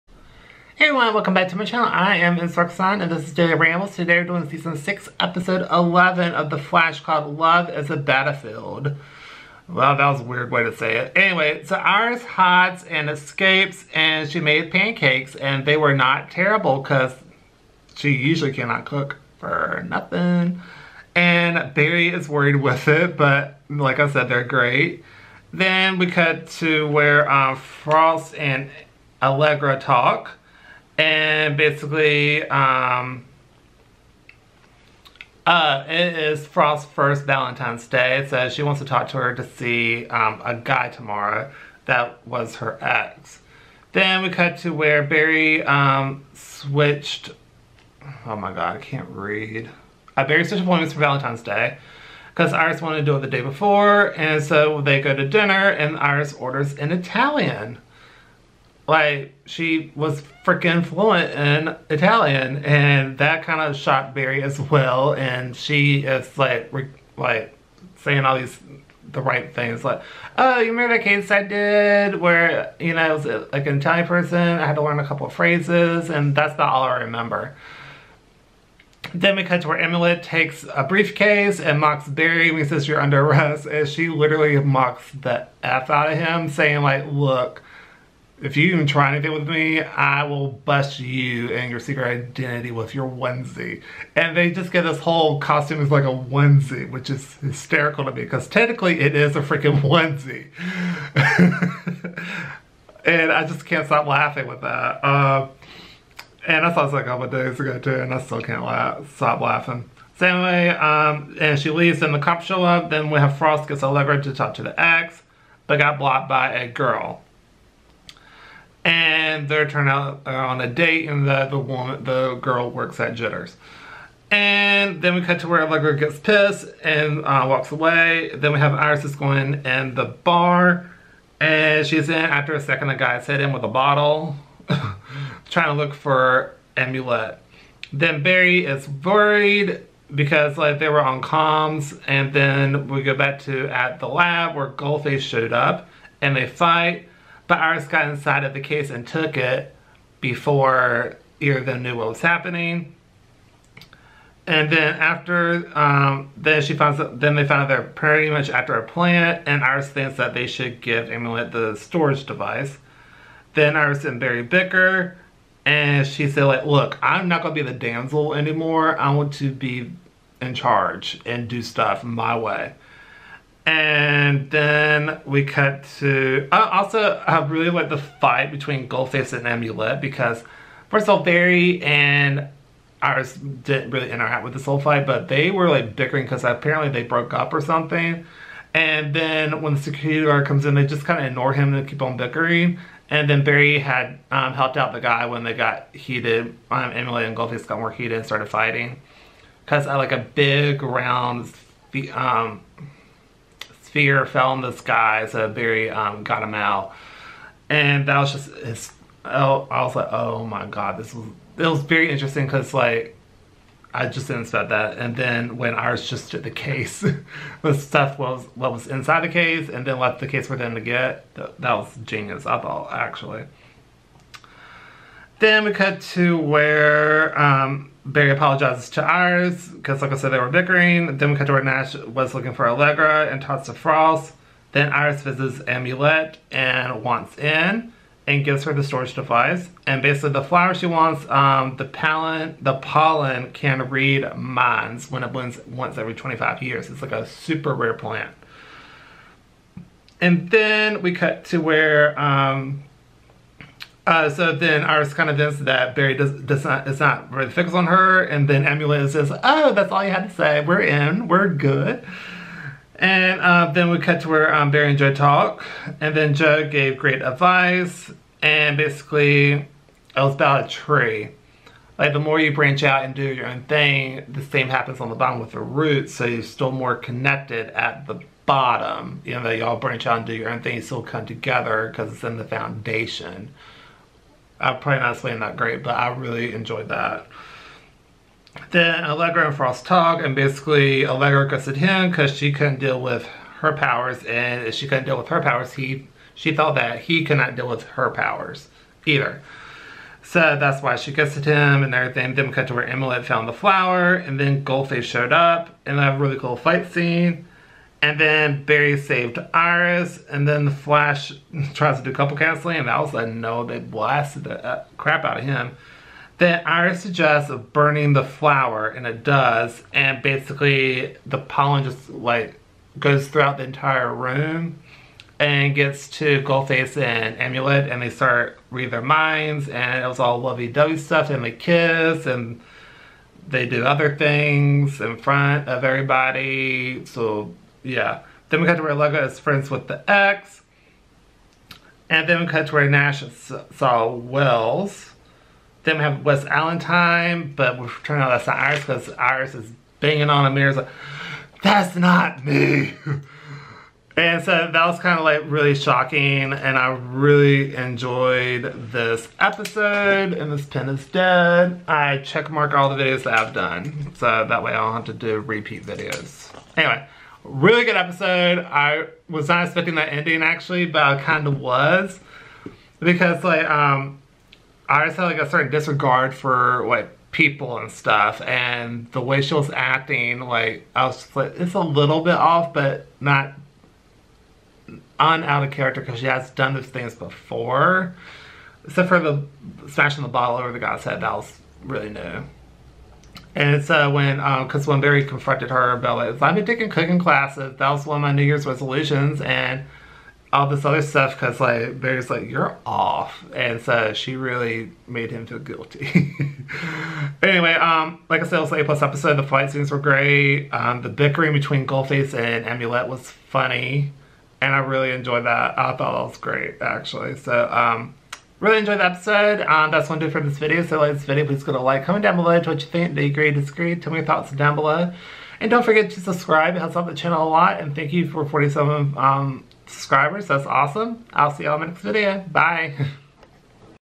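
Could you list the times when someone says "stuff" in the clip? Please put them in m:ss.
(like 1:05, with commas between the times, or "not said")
2:51, 3:37, 5:30, 6:17, 6:41.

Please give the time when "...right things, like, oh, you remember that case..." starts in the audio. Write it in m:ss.
1:09.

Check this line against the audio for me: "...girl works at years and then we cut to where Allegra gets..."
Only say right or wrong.
wrong.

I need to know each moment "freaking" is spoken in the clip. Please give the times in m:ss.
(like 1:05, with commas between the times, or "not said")
1:00, 1:39.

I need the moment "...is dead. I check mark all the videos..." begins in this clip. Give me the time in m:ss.
6:00.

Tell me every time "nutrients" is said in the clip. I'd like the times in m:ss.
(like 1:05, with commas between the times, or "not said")
not said.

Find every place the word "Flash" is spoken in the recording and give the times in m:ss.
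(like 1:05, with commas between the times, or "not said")
0:06, 5:10.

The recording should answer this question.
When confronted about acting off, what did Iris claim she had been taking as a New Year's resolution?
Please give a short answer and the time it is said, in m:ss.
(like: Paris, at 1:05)
cooking classes, at 6:36.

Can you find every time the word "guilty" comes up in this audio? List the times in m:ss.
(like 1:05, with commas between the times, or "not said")
6:45.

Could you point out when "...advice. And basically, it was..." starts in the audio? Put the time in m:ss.
4:27.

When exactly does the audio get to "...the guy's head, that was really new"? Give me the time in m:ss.
6:30.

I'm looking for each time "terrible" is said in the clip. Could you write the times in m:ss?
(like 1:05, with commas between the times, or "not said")
0:16.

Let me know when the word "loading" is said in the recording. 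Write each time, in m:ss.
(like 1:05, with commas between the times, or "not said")
not said.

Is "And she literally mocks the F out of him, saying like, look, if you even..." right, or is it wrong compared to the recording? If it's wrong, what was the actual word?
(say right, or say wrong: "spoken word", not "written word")
right.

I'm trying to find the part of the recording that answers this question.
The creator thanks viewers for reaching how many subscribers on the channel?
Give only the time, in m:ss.
7:08.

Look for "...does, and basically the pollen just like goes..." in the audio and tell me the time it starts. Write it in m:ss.
5:19.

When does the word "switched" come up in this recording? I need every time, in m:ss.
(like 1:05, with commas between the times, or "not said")
0:46, 0:50.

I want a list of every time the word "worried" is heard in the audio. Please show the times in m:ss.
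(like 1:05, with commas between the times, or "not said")
0:22, 2:18.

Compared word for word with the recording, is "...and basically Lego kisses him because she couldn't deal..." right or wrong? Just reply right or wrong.
wrong.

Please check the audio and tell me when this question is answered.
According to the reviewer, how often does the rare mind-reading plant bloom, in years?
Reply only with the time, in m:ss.
4:06.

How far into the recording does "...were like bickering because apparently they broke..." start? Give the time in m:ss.
3:05.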